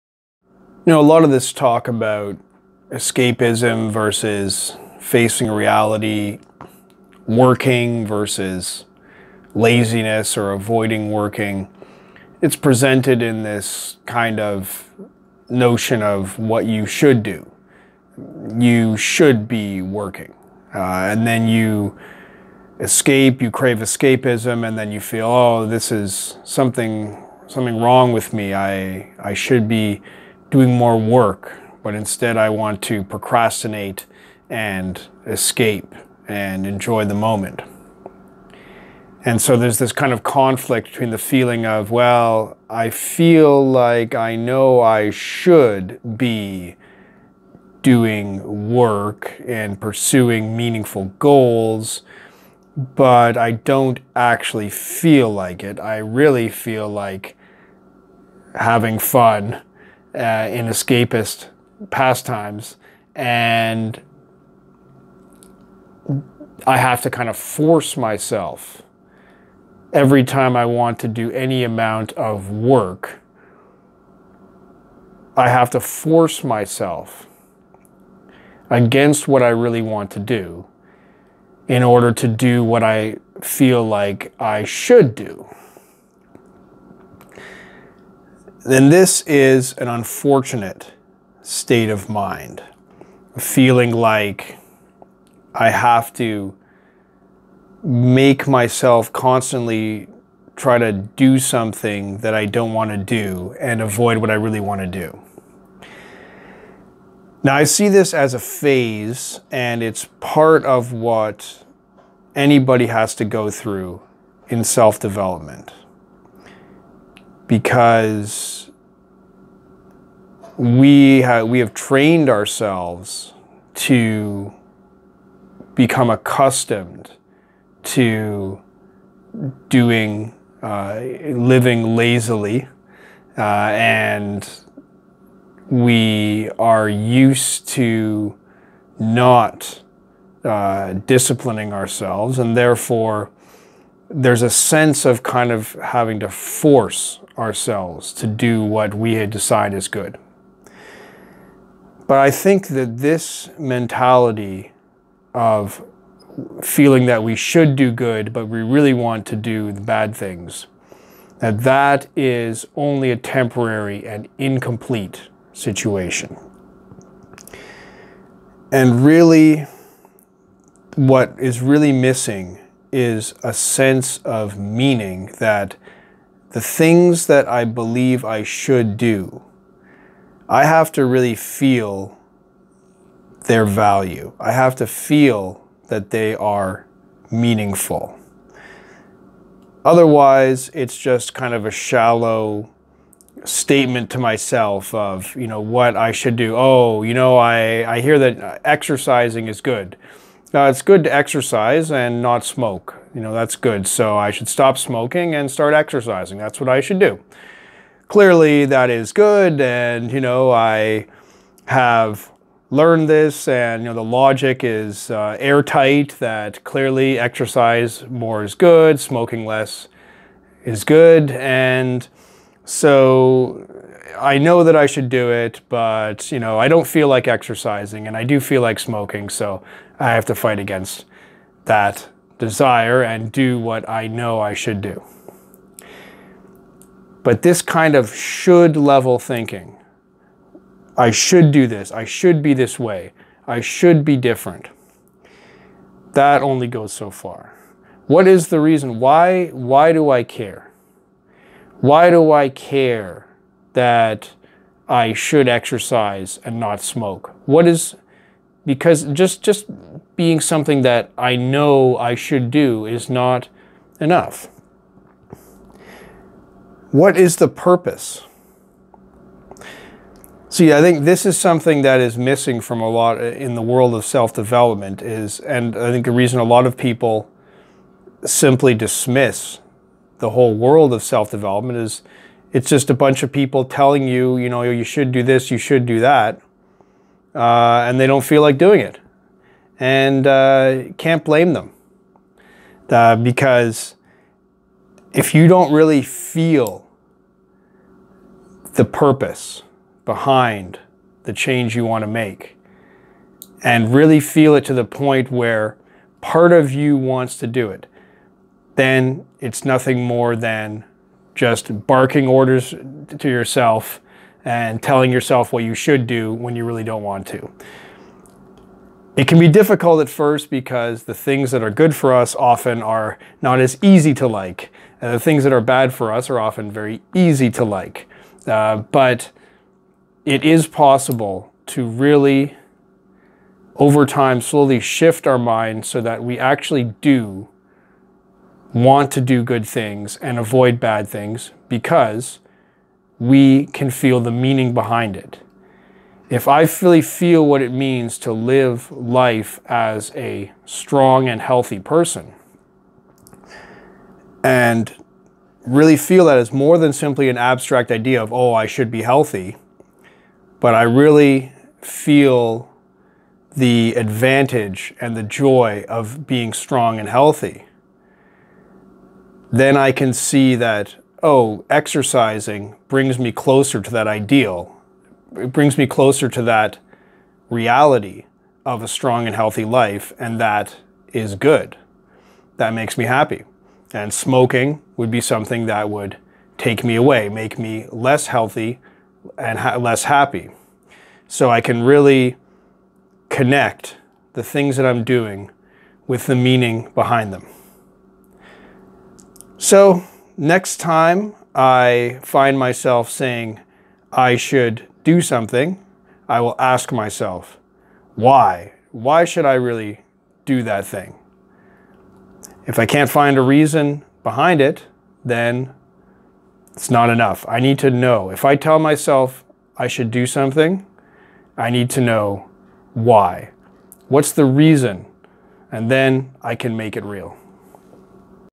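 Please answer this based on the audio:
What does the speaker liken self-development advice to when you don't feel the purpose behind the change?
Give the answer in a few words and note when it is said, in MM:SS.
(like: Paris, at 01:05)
barking orders, at 05:11.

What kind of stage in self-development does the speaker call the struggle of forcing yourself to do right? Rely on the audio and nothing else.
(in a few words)
a phase.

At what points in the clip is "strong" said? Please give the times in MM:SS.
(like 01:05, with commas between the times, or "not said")
05:50, 06:06, 06:18.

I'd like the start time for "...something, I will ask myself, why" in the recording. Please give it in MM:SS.
06:45.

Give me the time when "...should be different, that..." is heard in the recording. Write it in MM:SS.
04:03.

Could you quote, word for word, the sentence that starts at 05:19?
It can be difficult at first because the things that are good for us often are not as easy to like.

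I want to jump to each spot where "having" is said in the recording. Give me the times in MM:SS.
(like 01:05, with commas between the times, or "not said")
00:58, 02:25.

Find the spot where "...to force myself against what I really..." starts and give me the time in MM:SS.
01:15.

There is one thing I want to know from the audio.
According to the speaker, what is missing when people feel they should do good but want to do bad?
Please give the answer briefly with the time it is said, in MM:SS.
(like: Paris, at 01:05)
a sense of meaning, at 02:53.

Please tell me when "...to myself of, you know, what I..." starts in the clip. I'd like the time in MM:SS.
03:14.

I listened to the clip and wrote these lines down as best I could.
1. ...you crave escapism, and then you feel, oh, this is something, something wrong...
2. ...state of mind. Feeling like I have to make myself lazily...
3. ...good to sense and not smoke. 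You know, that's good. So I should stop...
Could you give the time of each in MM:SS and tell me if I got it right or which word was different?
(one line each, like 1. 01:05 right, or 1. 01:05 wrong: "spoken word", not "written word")
1. 00:23 right
2. 01:31 wrong: "constantly", not "lazily"
3. 03:20 wrong: "exercise", not "sense".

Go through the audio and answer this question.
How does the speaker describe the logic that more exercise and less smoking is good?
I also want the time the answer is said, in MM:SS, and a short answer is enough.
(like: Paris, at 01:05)
airtight, at 03:35.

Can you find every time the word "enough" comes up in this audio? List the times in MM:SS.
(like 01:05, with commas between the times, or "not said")
04:23, 06:57.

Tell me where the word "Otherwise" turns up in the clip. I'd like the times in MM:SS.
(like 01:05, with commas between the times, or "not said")
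03:09.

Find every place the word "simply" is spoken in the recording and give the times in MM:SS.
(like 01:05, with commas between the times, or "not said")
04:38, 05:56.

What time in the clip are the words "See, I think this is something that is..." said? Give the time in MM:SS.
04:30.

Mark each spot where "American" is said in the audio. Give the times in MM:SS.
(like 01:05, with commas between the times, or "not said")
not said.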